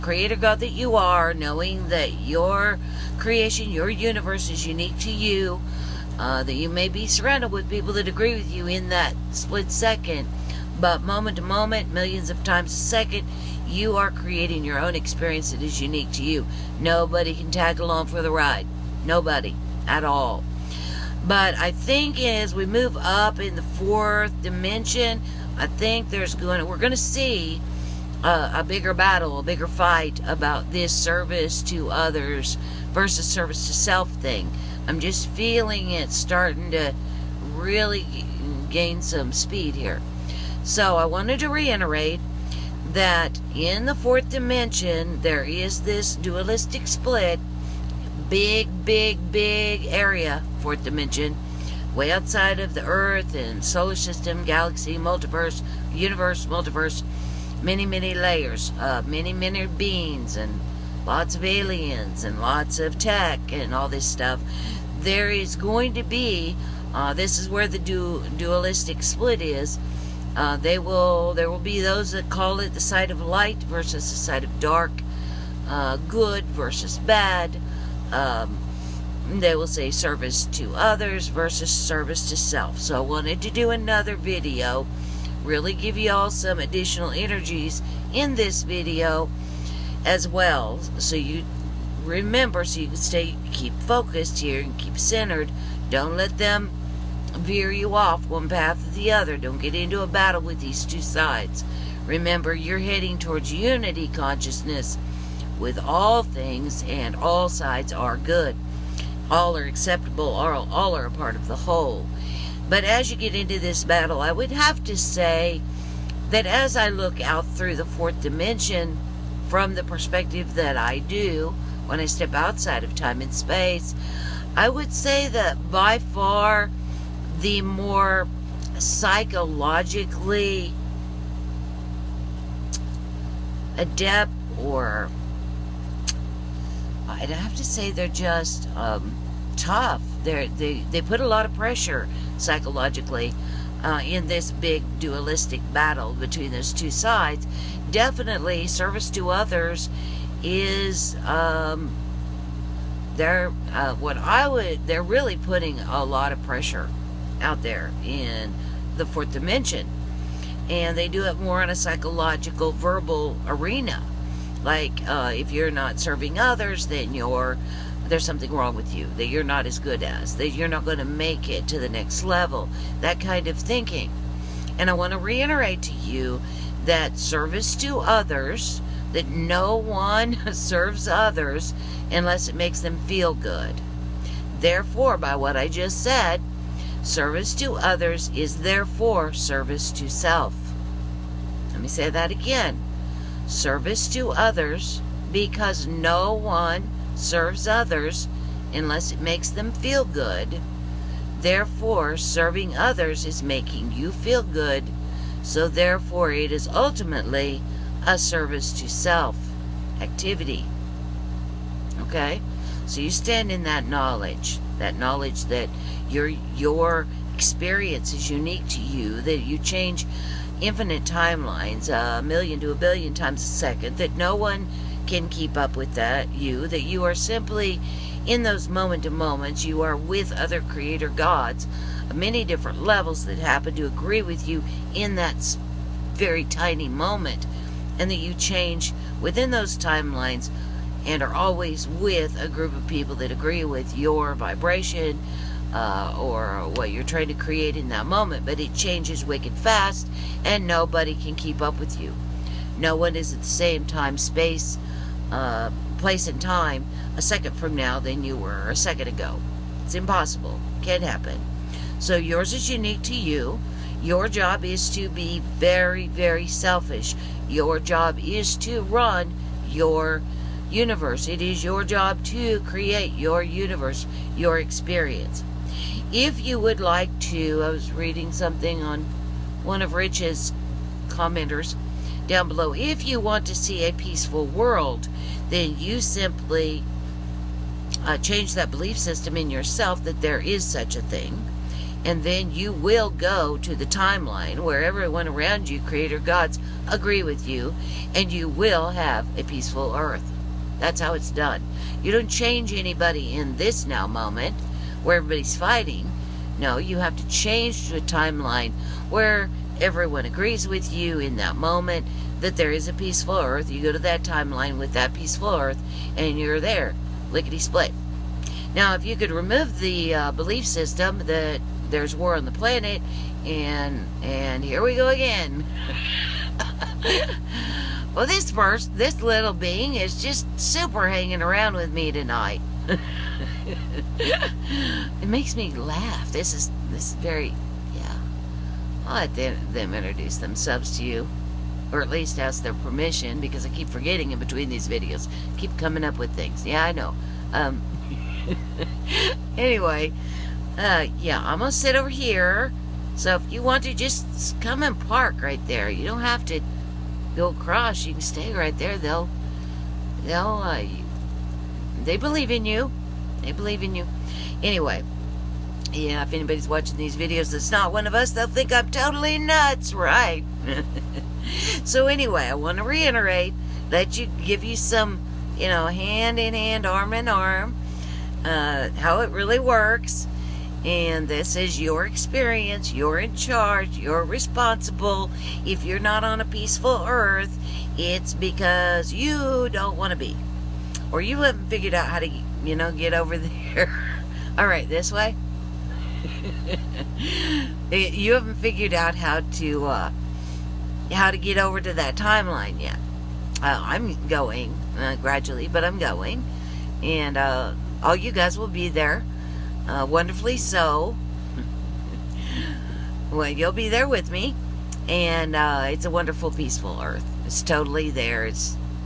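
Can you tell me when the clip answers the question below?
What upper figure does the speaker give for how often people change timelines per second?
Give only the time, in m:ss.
3:42.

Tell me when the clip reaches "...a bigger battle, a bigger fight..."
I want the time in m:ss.
0:28.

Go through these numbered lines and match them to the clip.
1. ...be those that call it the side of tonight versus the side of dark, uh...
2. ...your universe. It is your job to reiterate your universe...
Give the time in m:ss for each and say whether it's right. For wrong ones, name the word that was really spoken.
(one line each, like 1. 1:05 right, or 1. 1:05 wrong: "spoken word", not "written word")
1. 1:11 wrong: "light", not "tonight"
2. 4:29 wrong: "create", not "reiterate".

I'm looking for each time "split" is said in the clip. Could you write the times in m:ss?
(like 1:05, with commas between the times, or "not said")
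0:09, 0:46, 1:09, 5:17.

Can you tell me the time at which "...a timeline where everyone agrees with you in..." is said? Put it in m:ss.
5:07.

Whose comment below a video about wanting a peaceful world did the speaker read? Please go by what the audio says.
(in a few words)
Rich.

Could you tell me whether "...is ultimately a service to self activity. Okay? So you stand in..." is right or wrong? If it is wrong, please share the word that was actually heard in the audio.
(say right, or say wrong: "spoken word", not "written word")
right.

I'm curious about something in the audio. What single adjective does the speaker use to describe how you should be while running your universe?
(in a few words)
selfish.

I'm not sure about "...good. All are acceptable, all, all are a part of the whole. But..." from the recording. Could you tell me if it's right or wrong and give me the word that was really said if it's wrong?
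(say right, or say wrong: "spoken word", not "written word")
right.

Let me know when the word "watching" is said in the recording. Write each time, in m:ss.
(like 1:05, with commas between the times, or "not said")
6:06.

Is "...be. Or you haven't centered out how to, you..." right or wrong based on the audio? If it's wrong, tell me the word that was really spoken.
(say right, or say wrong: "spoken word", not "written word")
wrong: "figured", not "centered".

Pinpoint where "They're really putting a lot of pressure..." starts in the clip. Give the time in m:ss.
2:34.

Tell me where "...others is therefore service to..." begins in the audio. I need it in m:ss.
3:07.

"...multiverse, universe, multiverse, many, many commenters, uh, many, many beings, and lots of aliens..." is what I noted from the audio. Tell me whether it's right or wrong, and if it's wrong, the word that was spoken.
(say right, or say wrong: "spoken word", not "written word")
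wrong: "layers", not "commenters".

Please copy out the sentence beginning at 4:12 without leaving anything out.
No one is at the same time, space, uh, place, and time a second from now than you were a second ago.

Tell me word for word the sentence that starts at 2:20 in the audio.
They're, they they put a lot of pressure psychologically uh, in this big dualistic battle between those two sides.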